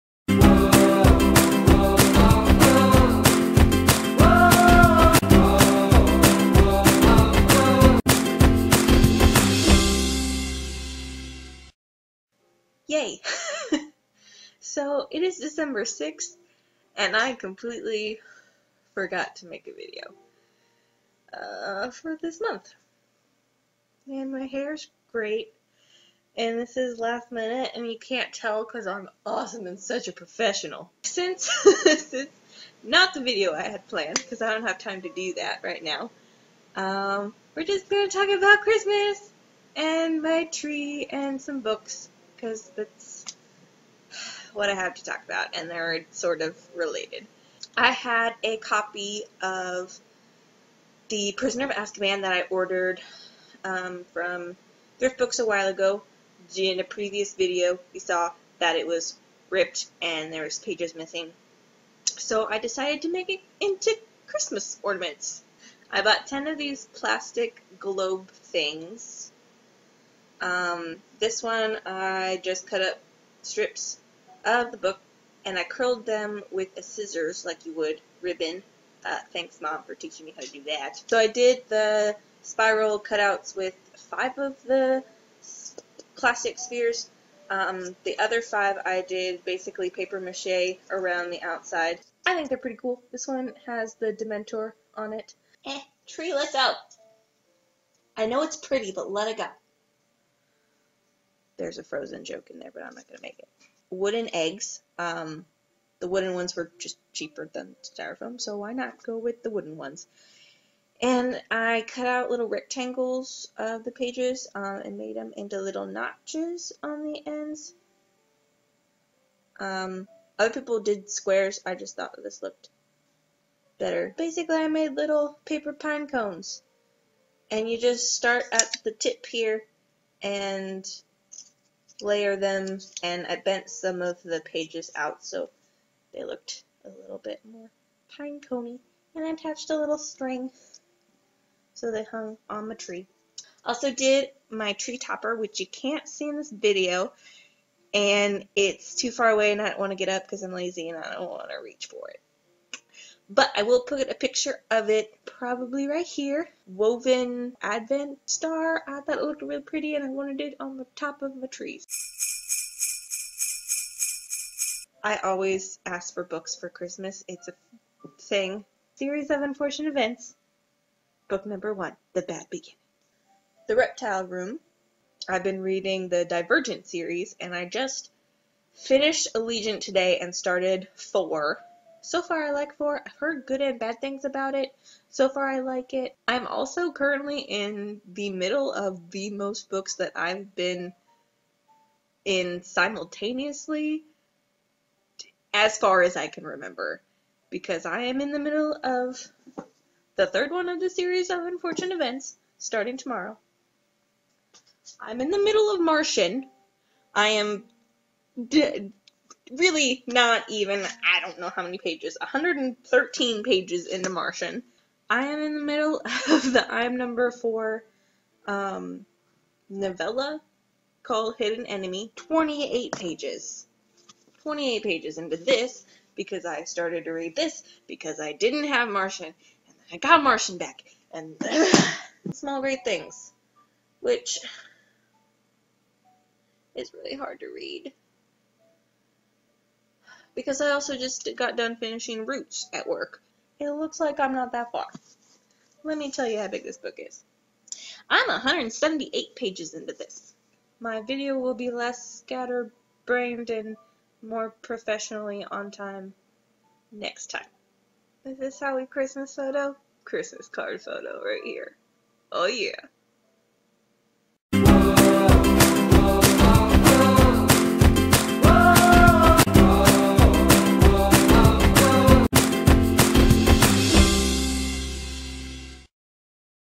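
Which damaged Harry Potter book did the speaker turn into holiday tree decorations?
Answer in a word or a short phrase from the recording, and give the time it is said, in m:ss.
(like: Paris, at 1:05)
The Prisoner of Azkaban, at 0:51.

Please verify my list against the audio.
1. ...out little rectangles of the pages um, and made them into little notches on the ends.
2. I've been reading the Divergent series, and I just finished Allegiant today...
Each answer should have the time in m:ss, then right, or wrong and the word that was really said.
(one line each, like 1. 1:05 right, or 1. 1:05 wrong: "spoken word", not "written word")
1. 1:52 right
2. 2:55 right.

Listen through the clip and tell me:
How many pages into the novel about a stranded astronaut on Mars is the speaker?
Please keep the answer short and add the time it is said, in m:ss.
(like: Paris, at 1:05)
113, at 3:32.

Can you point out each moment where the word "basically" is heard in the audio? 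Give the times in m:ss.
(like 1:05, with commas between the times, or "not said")
1:29, 2:04.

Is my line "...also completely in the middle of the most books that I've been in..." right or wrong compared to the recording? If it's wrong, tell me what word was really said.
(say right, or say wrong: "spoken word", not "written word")
wrong: "currently", not "completely".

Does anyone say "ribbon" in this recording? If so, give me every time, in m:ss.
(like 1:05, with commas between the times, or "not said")
1:18.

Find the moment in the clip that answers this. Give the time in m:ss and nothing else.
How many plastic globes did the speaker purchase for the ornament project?
1:06.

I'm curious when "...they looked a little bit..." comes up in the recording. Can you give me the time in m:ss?
2:16.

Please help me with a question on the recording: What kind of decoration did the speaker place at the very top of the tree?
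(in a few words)
Woven advent star.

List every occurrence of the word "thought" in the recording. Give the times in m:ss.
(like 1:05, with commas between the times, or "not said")
2:01, 2:38.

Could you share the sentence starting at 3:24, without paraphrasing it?
I'm in the middle of Martian.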